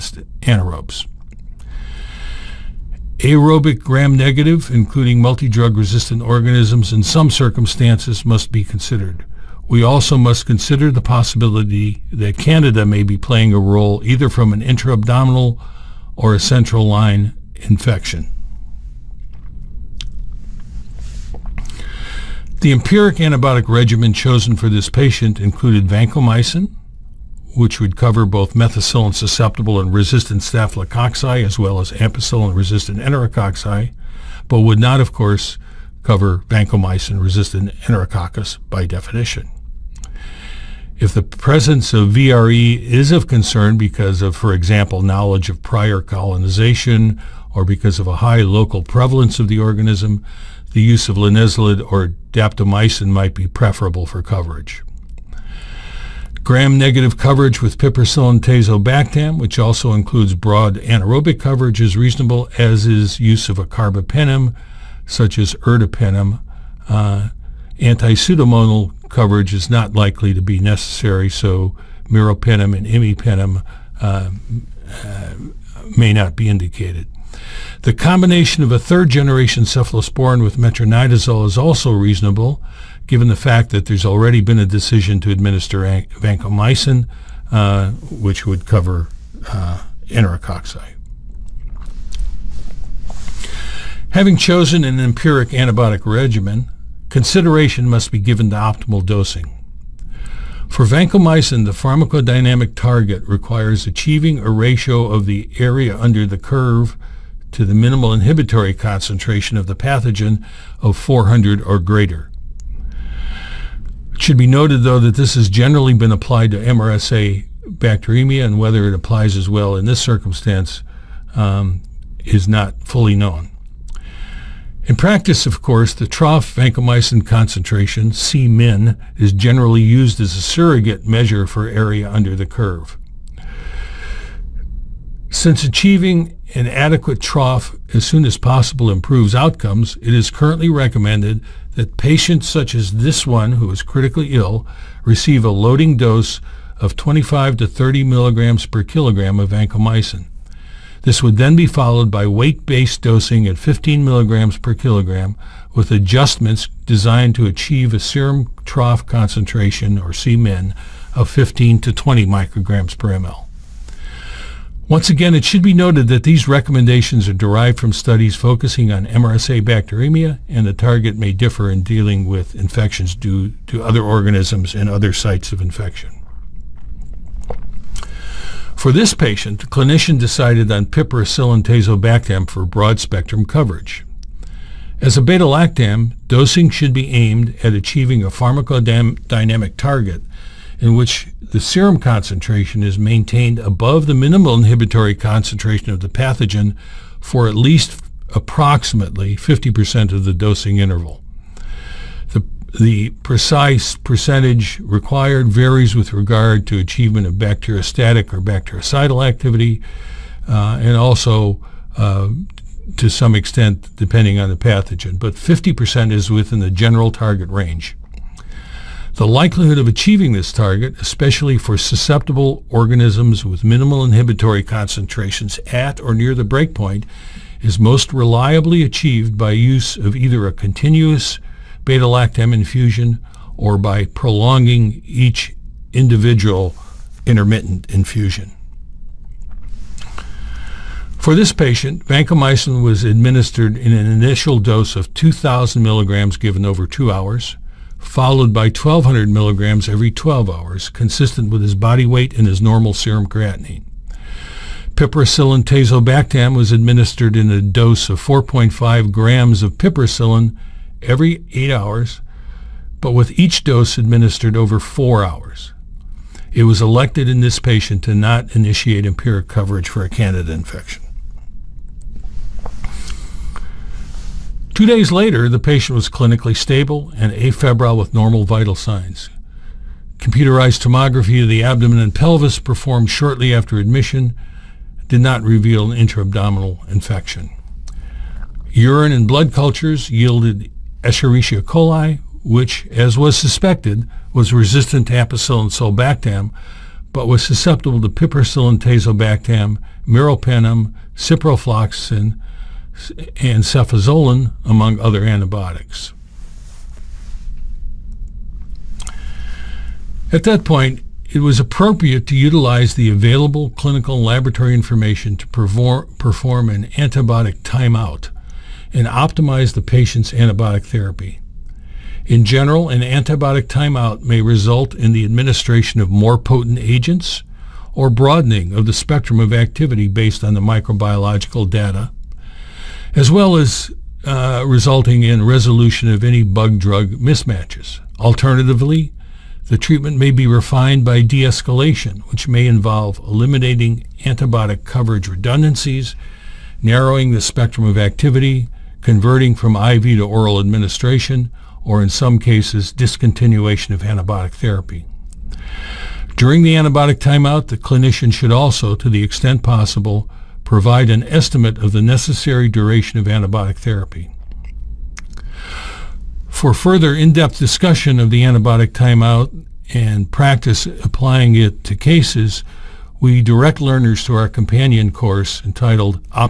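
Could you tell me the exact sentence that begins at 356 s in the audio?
During the antibiotic timeout, the clinician should also, to the extent possible, provide an estimate of the necessary duration of antibiotic therapy.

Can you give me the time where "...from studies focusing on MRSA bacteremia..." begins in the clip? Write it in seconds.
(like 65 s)
167 s.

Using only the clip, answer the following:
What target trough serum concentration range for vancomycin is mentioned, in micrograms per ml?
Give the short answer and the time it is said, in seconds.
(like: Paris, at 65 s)
15 to 20, at 161 s.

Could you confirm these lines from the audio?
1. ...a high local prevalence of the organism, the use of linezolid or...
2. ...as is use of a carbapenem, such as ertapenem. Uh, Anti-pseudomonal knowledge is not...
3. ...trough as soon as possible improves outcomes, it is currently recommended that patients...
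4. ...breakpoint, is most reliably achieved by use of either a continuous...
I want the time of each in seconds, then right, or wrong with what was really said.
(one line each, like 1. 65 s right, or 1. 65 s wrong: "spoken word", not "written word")
1. 48 s right
2. 62 s wrong: "coverage", not "knowledge"
3. 137 s right
4. 226 s right.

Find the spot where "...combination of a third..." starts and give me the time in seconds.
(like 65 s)
77 s.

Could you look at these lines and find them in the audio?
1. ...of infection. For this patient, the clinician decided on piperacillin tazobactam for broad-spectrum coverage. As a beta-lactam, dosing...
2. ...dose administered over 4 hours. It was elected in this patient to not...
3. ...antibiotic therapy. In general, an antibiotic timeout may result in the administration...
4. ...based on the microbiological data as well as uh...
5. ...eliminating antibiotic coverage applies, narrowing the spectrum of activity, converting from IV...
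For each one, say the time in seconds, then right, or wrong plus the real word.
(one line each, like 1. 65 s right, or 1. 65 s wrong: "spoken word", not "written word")
1. 175 s right
2. 263 s right
3. 320 s right
4. 330 s right
5. 343 s wrong: "redundancies", not "applies".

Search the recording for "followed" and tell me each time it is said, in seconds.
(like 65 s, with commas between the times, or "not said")
151 s, 247 s.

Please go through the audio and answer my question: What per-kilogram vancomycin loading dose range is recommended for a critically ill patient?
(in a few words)
25 to 30 mg/kg.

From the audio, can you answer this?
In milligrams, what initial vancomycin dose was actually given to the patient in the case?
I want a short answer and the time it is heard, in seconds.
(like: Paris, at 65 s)
2000, at 245 s.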